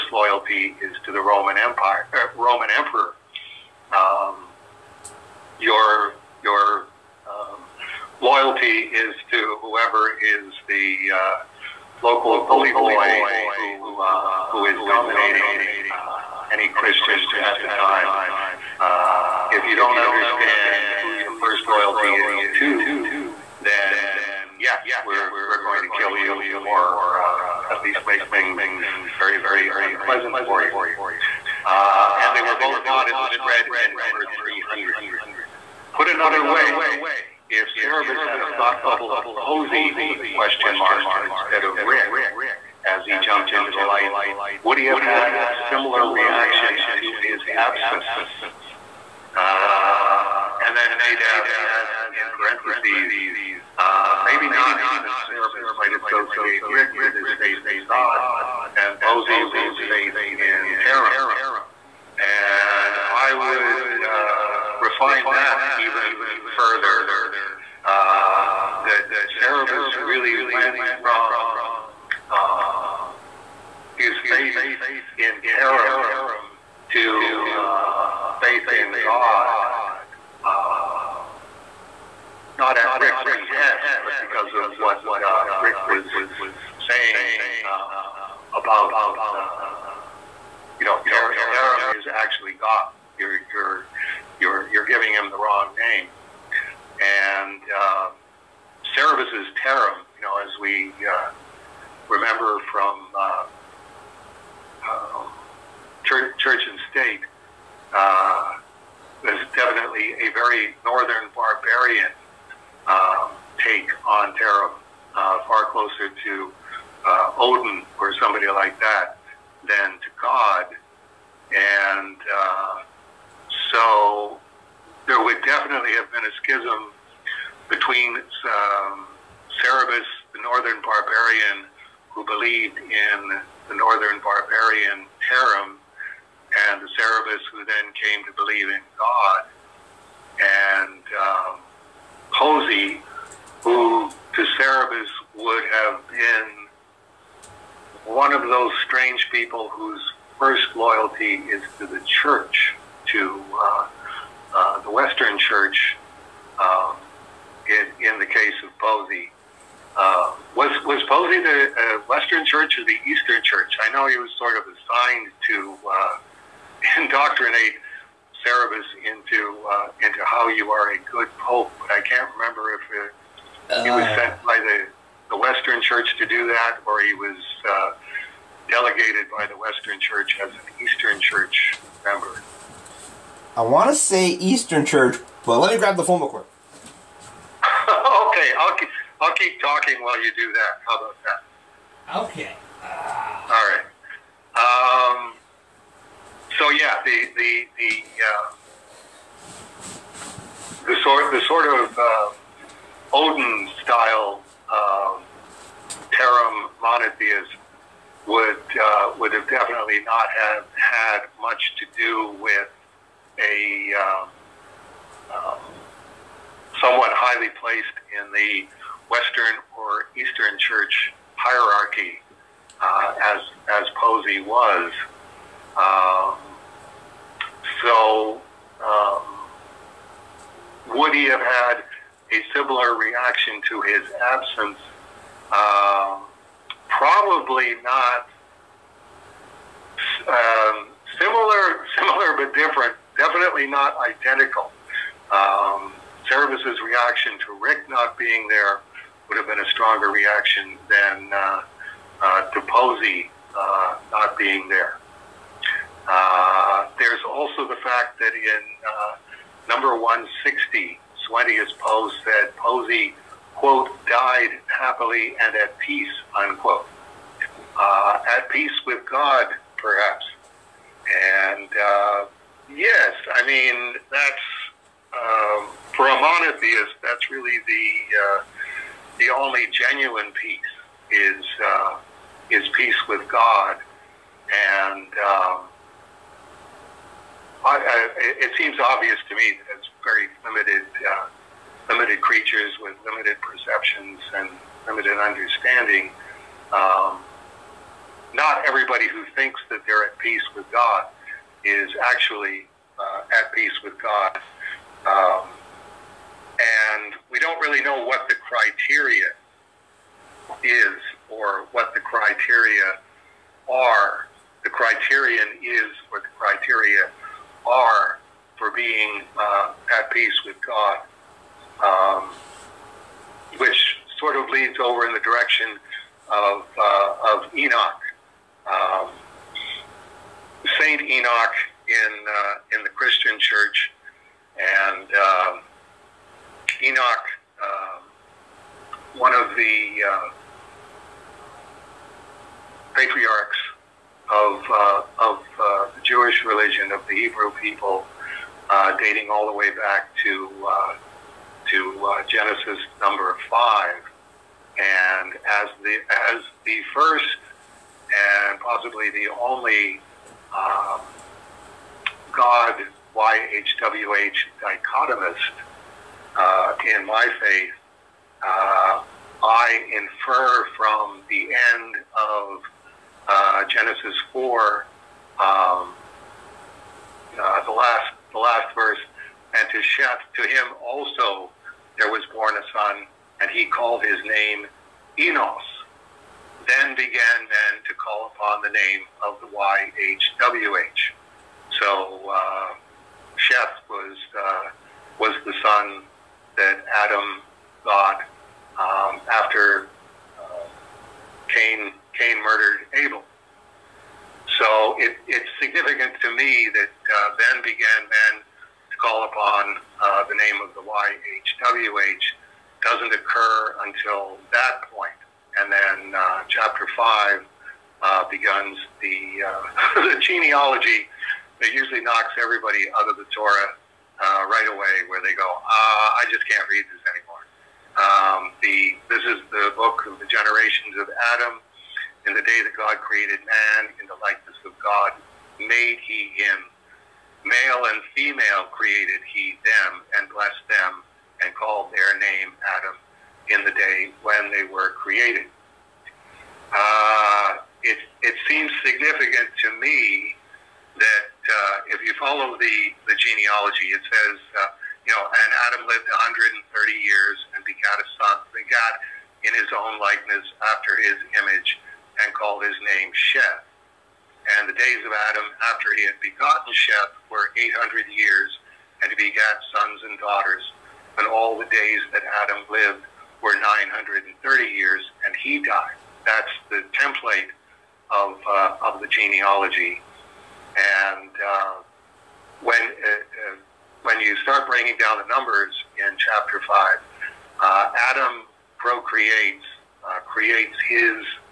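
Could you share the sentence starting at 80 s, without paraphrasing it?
Uh, not at Rick's behest, but because of what uh, Rick was saying uh, about, uh, you know, Tarim is actually God.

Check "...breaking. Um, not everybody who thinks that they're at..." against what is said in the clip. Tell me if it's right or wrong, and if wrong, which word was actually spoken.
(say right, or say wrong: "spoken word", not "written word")
wrong: "understanding", not "breaking".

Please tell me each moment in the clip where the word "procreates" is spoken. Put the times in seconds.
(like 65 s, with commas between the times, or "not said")
488 s.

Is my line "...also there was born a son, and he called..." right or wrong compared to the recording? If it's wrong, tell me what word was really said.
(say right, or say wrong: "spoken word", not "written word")
right.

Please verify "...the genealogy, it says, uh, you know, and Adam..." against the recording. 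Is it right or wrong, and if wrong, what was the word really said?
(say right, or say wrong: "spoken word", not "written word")
right.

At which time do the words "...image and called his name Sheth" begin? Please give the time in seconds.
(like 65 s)
461 s.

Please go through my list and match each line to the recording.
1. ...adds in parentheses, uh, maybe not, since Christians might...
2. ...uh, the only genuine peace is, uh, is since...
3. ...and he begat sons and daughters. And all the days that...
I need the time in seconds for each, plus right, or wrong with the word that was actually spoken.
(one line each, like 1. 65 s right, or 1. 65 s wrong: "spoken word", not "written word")
1. 51 s wrong: "Cerebus", not "Christians"
2. 278 s wrong: "peace", not "since"
3. 469 s right.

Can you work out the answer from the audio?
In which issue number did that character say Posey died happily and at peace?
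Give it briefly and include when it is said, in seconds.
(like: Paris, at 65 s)
160, at 259 s.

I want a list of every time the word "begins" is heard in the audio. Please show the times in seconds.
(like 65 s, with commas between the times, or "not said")
418 s.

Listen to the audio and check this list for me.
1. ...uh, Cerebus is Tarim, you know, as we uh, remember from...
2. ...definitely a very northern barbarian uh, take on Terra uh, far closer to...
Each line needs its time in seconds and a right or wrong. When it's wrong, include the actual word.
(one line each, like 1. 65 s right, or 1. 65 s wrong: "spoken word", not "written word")
1. 97 s right
2. 109 s right.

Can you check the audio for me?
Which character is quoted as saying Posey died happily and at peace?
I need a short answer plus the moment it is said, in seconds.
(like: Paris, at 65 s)
Suenteus Po, at 261 s.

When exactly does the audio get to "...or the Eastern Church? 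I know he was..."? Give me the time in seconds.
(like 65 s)
162 s.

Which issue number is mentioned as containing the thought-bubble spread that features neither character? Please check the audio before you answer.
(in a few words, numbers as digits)
300.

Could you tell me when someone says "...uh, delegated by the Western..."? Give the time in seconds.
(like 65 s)
177 s.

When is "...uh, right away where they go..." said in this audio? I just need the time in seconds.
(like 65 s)
424 s.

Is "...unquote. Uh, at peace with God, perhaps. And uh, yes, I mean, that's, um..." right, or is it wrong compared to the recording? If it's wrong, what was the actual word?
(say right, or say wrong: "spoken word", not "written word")
right.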